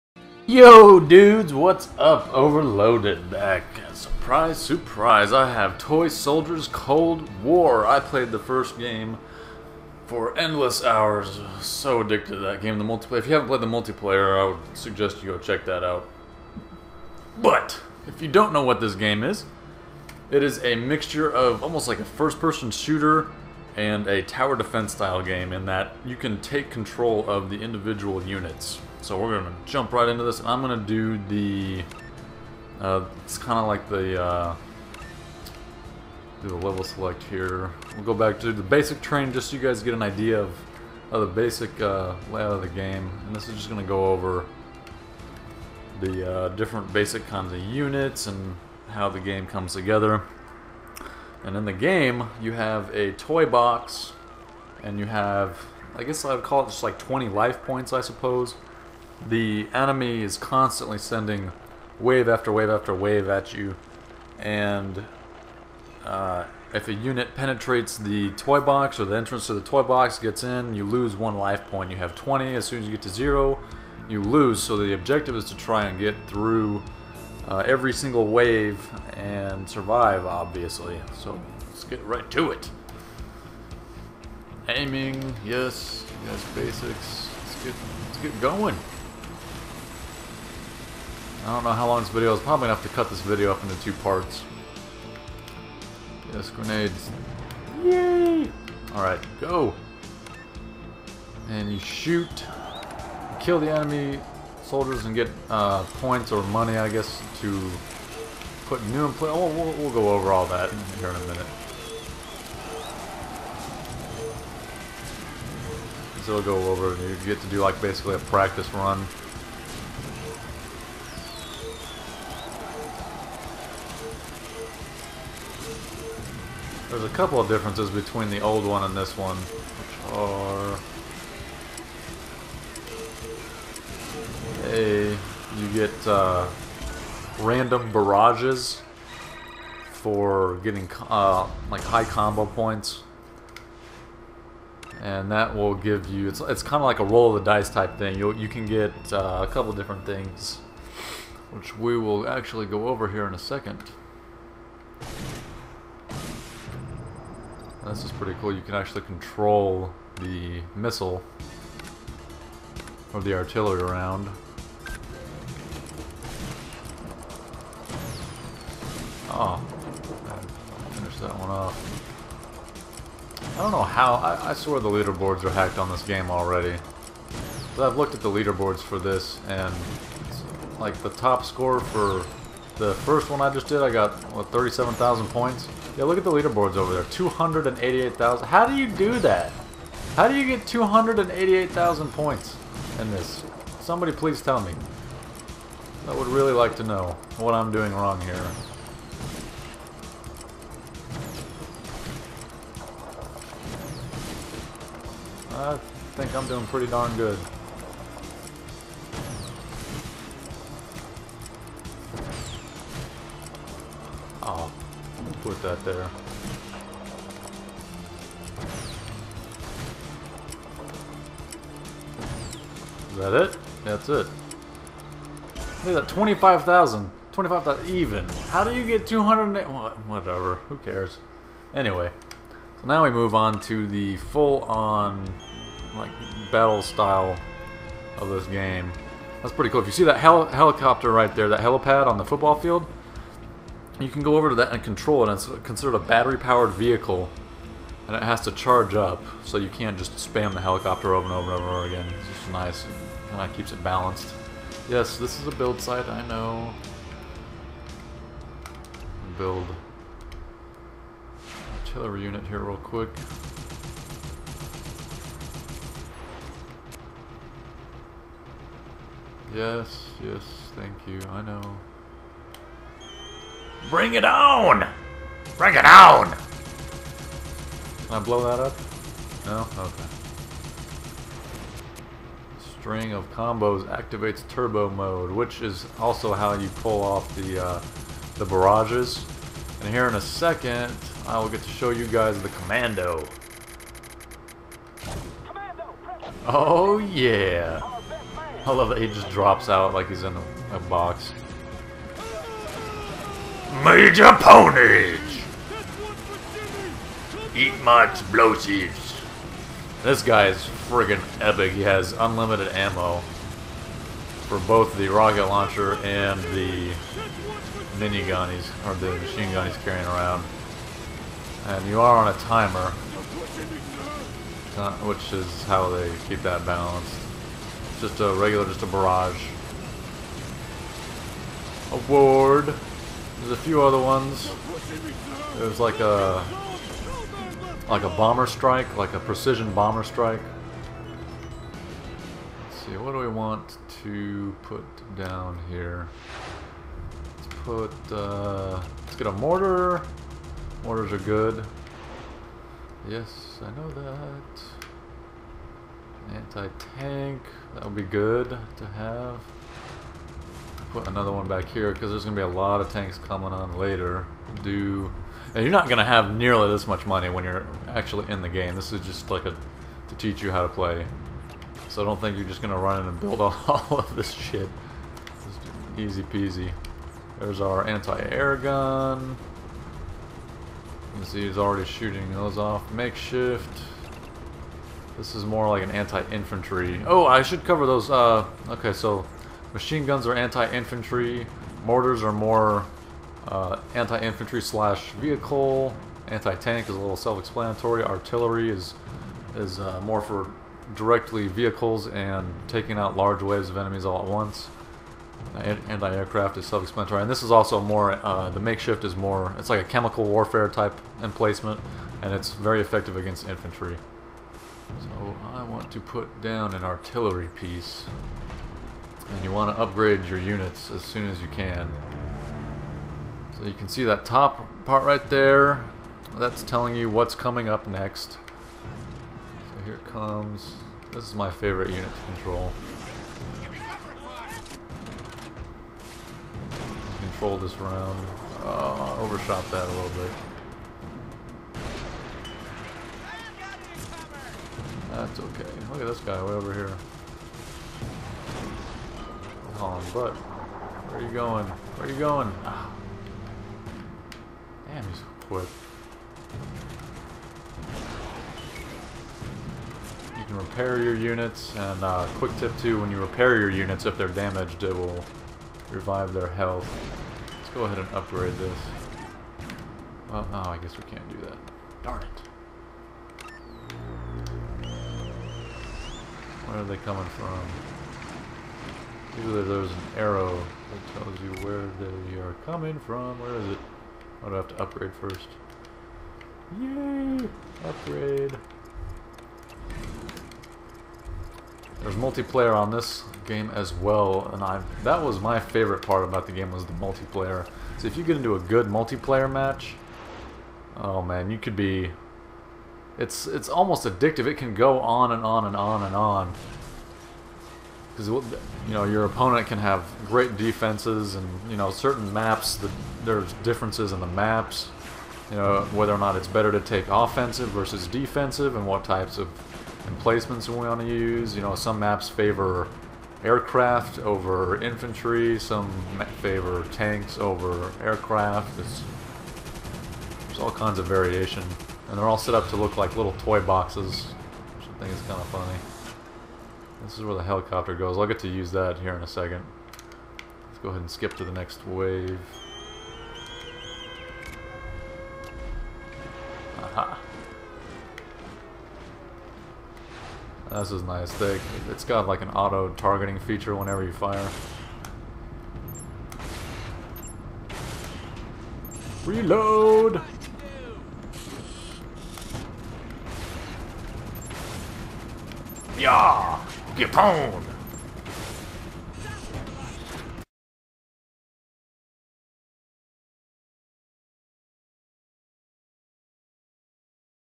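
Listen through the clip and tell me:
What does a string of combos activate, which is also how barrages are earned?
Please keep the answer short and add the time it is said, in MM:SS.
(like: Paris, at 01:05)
turbo mode, at 04:44.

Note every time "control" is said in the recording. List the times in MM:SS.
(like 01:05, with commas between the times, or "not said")
00:26, 02:39, 04:04, 07:12, 07:17.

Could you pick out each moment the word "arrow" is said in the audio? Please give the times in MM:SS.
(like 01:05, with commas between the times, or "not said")
08:00.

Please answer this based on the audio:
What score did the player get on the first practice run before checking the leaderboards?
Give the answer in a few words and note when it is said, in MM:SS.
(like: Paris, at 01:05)
37,000, at 03:04.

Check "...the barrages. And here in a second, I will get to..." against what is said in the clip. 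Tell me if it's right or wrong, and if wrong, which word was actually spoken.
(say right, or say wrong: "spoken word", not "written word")
right.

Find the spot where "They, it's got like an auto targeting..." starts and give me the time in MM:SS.
09:11.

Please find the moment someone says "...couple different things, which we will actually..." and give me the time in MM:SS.
02:29.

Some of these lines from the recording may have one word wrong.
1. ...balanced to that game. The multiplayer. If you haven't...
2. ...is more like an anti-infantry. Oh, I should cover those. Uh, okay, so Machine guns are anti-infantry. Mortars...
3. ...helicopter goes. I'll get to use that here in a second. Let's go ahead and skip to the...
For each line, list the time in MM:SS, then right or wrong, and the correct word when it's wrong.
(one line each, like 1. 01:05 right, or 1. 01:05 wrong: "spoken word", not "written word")
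1. 00:12 wrong: "addicted", not "balanced"
2. 06:25 right
3. 08:57 right.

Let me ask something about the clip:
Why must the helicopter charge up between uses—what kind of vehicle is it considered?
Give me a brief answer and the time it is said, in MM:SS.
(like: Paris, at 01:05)
battery-powered vehicle, at 04:05.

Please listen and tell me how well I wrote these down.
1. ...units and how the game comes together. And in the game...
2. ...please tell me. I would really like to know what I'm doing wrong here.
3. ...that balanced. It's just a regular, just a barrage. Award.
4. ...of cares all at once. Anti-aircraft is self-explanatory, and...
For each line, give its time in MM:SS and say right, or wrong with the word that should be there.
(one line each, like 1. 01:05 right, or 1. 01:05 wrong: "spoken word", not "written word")
1. 00:47 right
2. 03:14 right
3. 05:26 right
4. 06:43 wrong: "enemies", not "cares".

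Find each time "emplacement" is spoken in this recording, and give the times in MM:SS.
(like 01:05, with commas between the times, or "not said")
06:51, 08:40.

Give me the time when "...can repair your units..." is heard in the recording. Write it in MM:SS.
07:40.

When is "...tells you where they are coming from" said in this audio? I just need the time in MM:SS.
08:01.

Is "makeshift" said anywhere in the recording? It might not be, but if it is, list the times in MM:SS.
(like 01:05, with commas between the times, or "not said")
06:22, 06:48.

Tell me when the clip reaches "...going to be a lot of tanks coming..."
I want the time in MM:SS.
06:02.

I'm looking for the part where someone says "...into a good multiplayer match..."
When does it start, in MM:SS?
08:18.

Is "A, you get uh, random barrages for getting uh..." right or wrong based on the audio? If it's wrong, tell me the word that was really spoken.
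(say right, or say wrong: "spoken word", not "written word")
right.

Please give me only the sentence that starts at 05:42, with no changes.
Let's see, what do we want to put down here?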